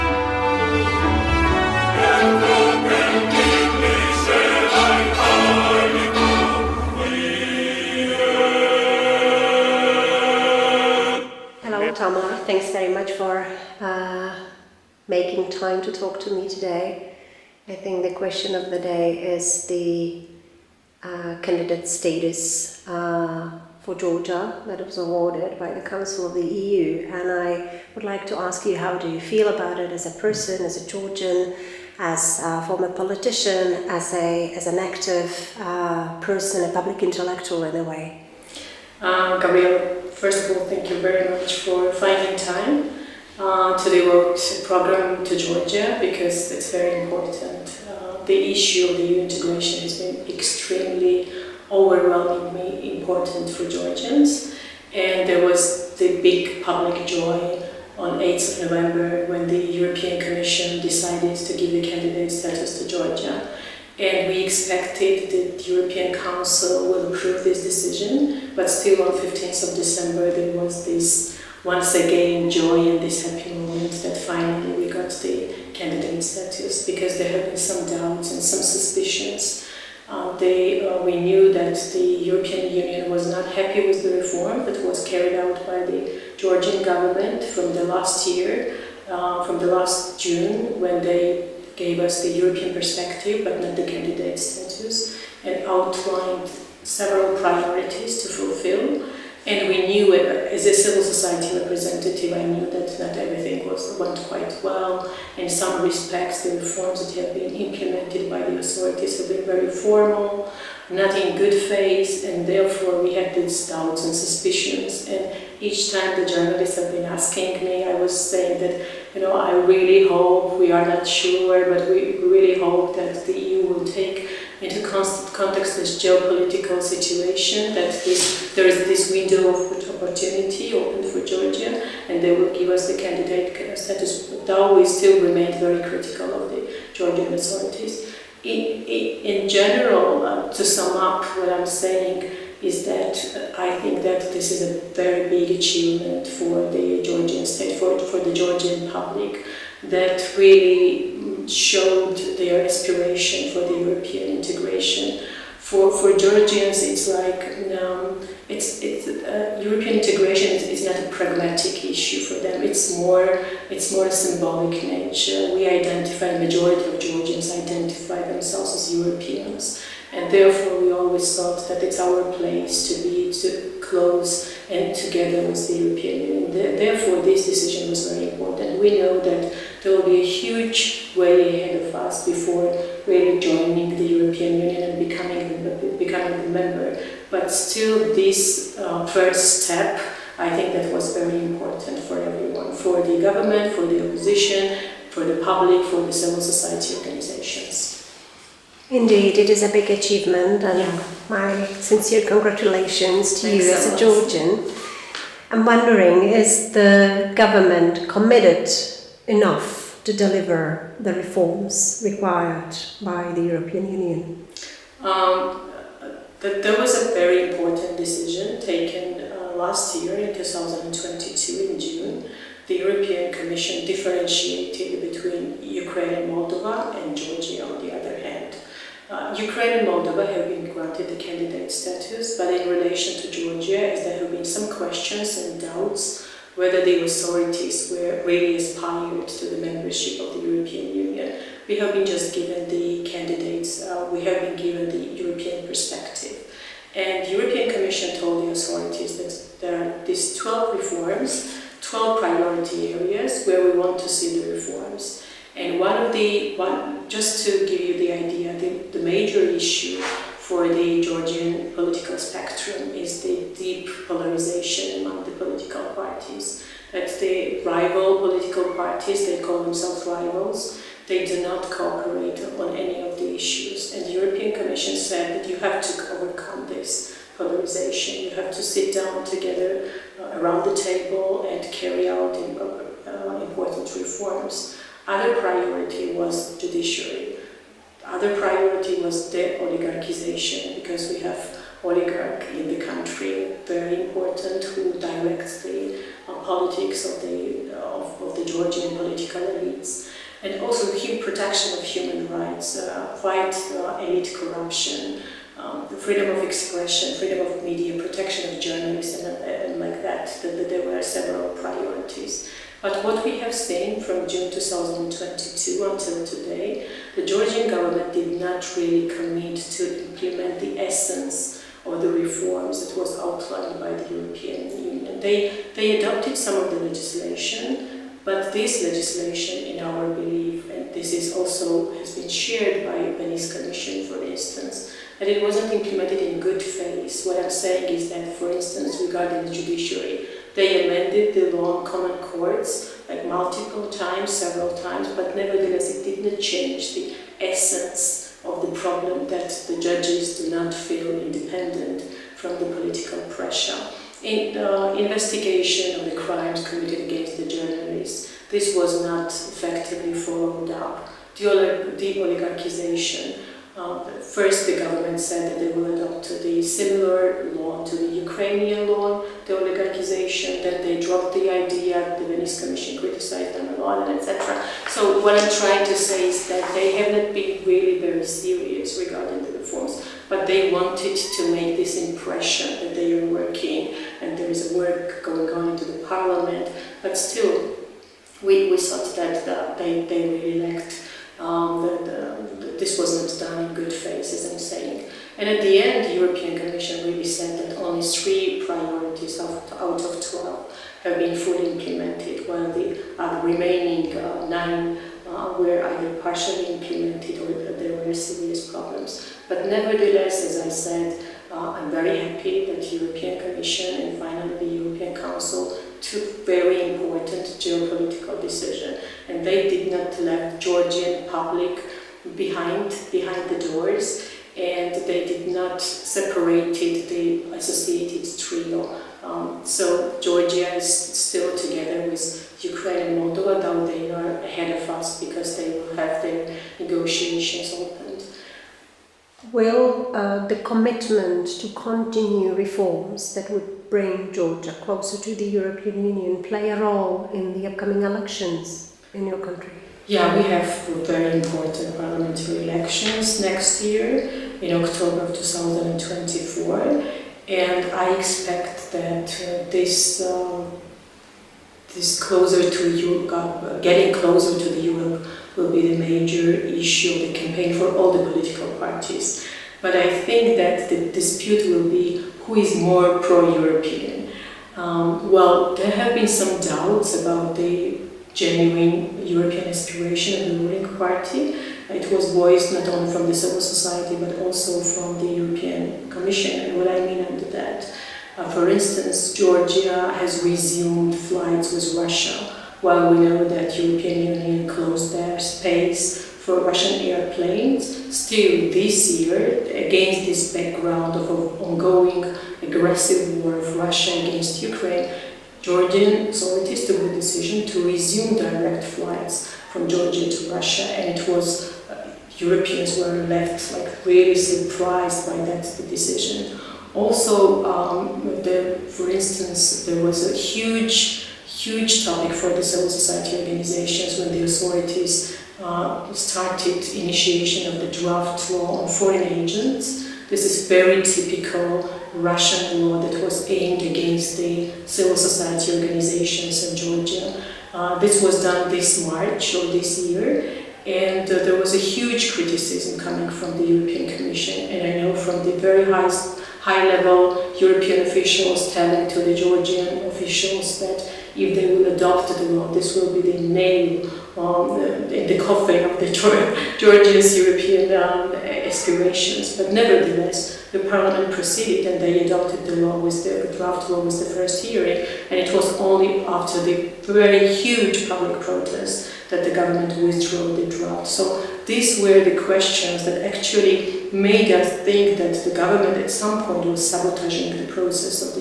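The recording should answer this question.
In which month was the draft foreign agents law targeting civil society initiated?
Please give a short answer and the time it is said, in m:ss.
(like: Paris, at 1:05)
March, at 8:59.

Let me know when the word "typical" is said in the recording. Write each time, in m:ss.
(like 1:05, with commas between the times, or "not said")
8:51.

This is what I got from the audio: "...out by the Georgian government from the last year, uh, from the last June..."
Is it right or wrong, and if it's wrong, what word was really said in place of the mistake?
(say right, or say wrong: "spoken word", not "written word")
right.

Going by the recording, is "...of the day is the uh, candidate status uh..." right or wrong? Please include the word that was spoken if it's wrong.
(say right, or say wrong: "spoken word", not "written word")
right.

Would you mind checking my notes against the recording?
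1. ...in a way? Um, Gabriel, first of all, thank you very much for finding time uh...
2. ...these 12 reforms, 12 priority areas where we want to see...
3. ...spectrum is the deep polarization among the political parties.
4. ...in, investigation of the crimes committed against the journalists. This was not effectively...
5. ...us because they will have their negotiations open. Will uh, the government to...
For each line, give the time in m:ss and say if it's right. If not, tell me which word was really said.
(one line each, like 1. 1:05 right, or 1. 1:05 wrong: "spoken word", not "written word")
1. 0:37 right
2. 4:10 right
3. 4:22 right
4. 5:54 right
5. 7:14 wrong: "commitment", not "government".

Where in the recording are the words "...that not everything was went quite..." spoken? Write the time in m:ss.
1:42.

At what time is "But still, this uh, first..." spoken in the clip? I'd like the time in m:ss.
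3:07.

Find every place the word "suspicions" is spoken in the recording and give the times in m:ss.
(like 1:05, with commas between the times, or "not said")
1:18, 1:54.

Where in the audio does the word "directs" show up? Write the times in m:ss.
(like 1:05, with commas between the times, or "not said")
4:54, 8:28.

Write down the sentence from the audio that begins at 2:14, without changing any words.
though we still remain very critical of the Georgian authorities.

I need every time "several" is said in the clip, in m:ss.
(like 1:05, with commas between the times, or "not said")
1:36, 5:11, 5:44.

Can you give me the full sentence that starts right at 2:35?
For, for Georgians, it's like um, it's, it's, uh, European integration is, is, not a pragmatic issue for them.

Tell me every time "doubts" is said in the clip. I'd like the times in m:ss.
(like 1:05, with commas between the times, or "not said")
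1:17, 1:53, 3:55, 7:56.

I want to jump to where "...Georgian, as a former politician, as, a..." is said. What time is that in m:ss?
0:30.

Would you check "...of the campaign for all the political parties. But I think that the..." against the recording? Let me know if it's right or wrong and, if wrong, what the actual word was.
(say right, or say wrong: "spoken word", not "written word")
right.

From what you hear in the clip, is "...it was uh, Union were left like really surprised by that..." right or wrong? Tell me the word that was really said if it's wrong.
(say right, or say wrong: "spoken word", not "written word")
wrong: "Europeans", not "Union".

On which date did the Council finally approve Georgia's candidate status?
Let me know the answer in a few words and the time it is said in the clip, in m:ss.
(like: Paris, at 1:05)
15th of December, at 1:09.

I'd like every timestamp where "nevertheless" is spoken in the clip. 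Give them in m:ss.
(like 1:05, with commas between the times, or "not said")
5:45, 6:49, 9:19.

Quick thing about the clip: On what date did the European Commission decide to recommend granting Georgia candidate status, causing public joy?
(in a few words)
8th of November.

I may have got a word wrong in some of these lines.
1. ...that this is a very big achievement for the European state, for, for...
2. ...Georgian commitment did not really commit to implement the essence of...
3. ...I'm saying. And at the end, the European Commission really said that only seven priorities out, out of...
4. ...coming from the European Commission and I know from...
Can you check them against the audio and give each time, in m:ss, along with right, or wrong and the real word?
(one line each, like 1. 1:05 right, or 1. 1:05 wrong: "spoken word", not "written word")
1. 2:24 wrong: "Georgian", not "European"
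2. 5:17 wrong: "government", not "commitment"
3. 6:34 wrong: "three", not "seven"
4. 9:02 right.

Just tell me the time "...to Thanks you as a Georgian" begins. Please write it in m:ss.
3:23.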